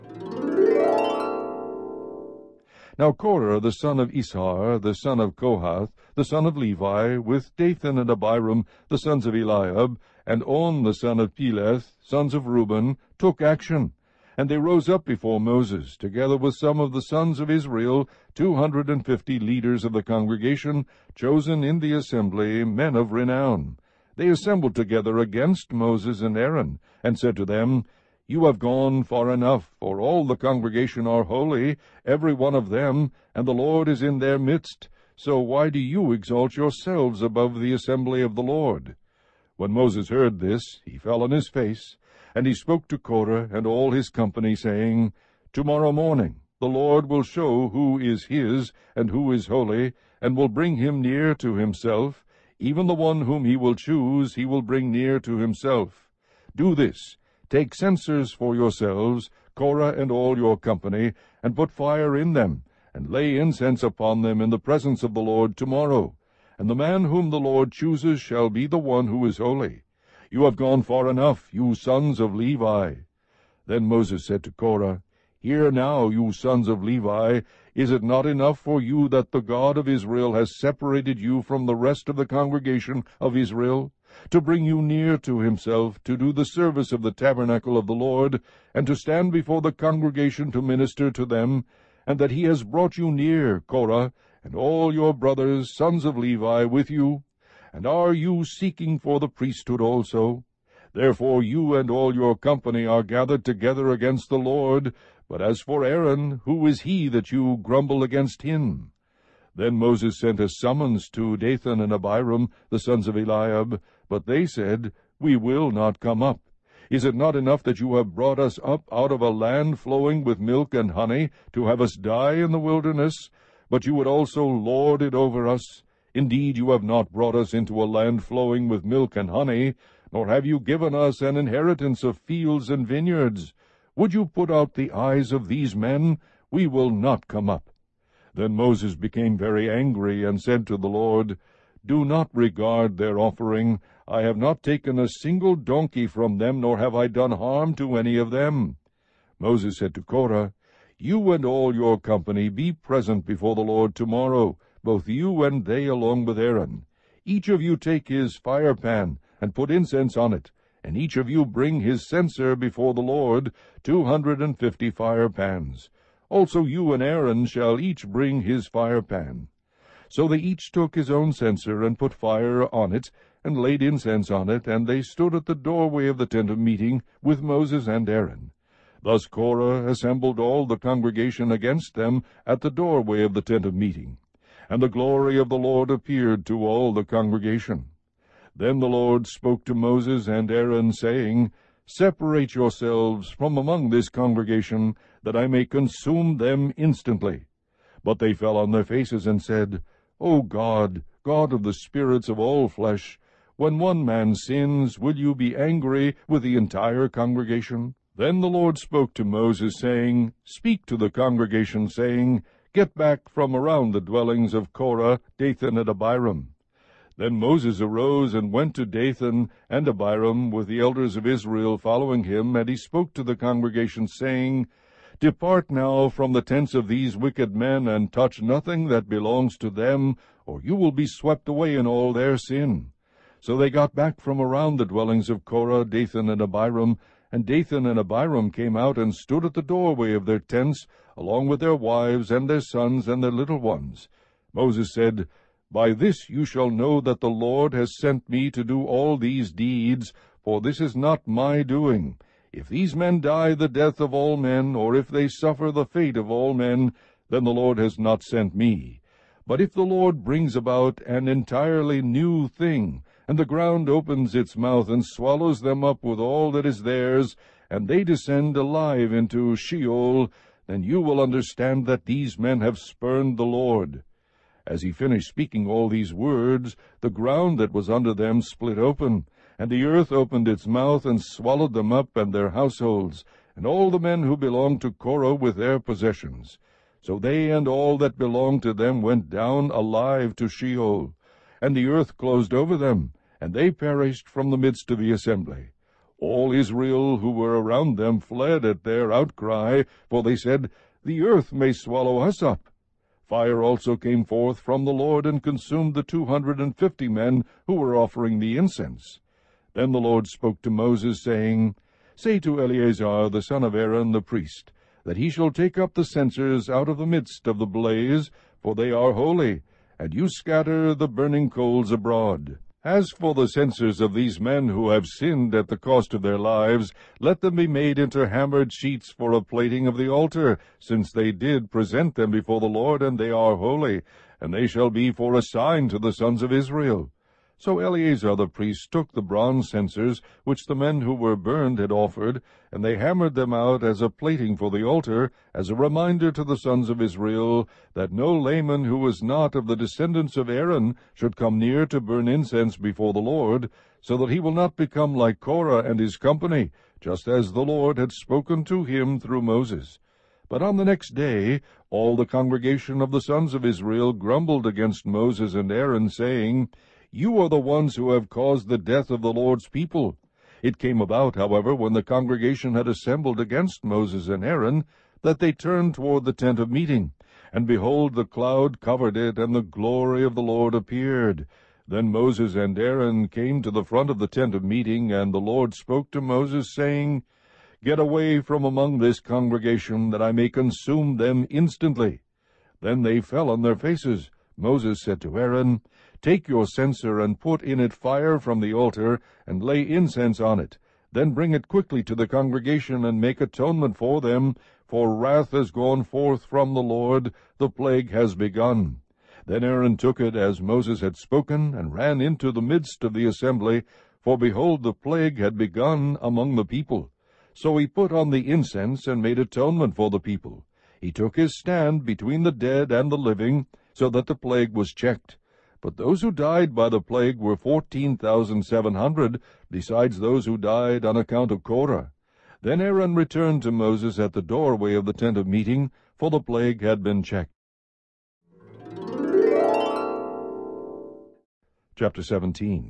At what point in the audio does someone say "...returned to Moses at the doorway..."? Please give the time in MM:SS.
07:13.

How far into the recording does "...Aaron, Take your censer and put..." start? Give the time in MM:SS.
06:35.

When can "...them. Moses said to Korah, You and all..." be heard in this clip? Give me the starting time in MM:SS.
02:28.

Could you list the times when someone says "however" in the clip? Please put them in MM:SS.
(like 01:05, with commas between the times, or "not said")
06:11.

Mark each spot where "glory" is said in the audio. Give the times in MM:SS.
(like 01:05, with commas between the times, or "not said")
03:04, 06:19.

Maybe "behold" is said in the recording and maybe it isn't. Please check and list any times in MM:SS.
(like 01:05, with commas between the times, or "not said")
06:17, 06:54.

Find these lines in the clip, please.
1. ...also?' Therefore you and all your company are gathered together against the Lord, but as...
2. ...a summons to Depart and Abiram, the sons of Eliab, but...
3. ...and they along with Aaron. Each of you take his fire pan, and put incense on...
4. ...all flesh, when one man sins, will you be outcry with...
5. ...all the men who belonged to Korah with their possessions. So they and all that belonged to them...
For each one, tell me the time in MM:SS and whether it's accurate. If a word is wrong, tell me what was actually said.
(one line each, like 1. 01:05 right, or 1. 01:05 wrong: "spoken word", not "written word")
1. 01:39 right
2. 01:50 wrong: "Dathan", not "Depart"
3. 02:35 right
4. 03:22 wrong: "angry", not "outcry"
5. 04:43 right.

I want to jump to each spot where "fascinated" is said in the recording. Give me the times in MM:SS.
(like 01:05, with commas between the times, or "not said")
not said.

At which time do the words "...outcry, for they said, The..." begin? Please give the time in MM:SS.
04:59.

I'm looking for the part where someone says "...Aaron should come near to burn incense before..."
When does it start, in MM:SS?
05:50.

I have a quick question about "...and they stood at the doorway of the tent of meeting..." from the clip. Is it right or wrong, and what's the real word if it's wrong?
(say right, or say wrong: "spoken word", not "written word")
right.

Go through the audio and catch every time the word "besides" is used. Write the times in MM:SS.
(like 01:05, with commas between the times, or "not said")
07:09.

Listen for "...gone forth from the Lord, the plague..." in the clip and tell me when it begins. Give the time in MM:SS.
06:45.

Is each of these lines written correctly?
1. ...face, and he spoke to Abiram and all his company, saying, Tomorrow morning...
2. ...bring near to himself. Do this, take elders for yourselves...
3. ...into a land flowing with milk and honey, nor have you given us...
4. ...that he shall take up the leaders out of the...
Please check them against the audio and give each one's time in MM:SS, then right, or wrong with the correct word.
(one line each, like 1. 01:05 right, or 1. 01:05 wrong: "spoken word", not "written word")
1. 00:41 wrong: "Korah", not "Abiram"
2. 00:54 wrong: "censers", not "elders"
3. 02:07 right
4. 05:15 wrong: "censers", not "leaders".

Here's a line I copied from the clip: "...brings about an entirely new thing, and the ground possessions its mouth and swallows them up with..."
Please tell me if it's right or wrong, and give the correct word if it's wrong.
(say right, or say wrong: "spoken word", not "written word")
wrong: "opens", not "possessions".